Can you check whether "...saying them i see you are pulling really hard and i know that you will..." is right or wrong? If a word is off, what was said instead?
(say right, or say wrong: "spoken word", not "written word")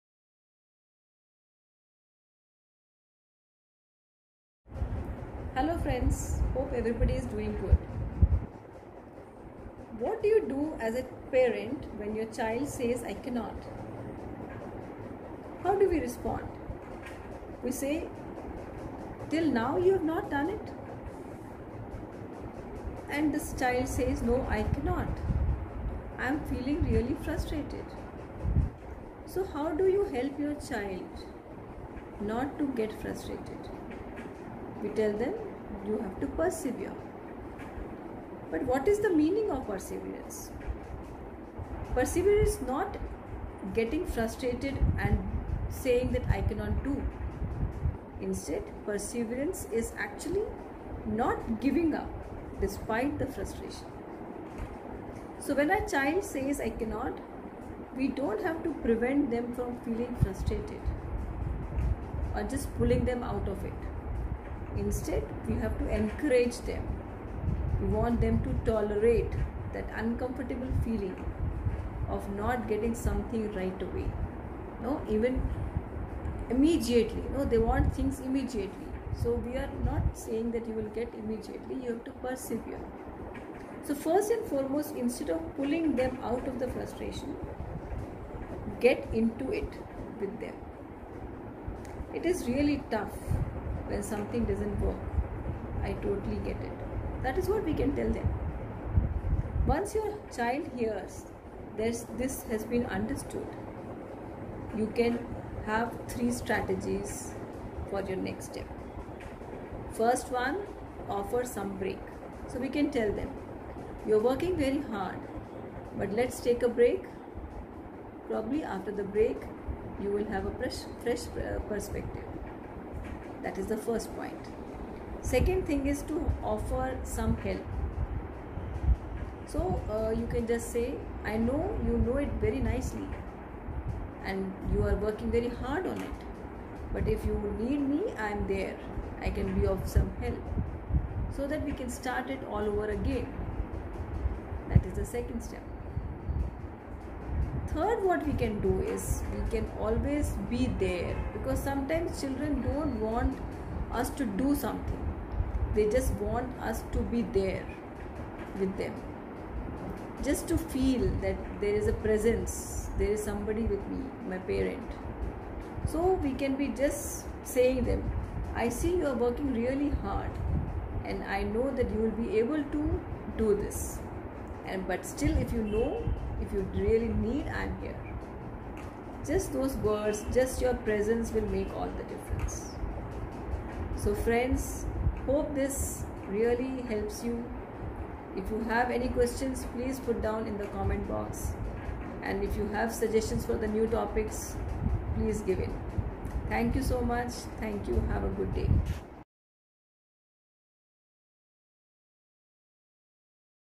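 wrong: "working", not "pulling".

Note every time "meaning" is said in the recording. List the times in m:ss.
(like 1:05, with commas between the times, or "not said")
0:39.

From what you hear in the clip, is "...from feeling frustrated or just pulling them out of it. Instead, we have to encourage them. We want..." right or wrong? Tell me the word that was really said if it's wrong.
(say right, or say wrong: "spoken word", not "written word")
right.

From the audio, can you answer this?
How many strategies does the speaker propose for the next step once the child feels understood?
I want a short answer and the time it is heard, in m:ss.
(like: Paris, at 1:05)
3, at 1:46.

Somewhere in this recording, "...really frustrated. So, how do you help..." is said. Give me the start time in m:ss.
0:26.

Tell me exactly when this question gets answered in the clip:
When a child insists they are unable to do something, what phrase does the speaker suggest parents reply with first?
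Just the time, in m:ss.
0:19.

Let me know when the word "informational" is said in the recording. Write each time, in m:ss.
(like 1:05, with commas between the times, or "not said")
not said.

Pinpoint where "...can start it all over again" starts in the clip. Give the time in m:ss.
2:21.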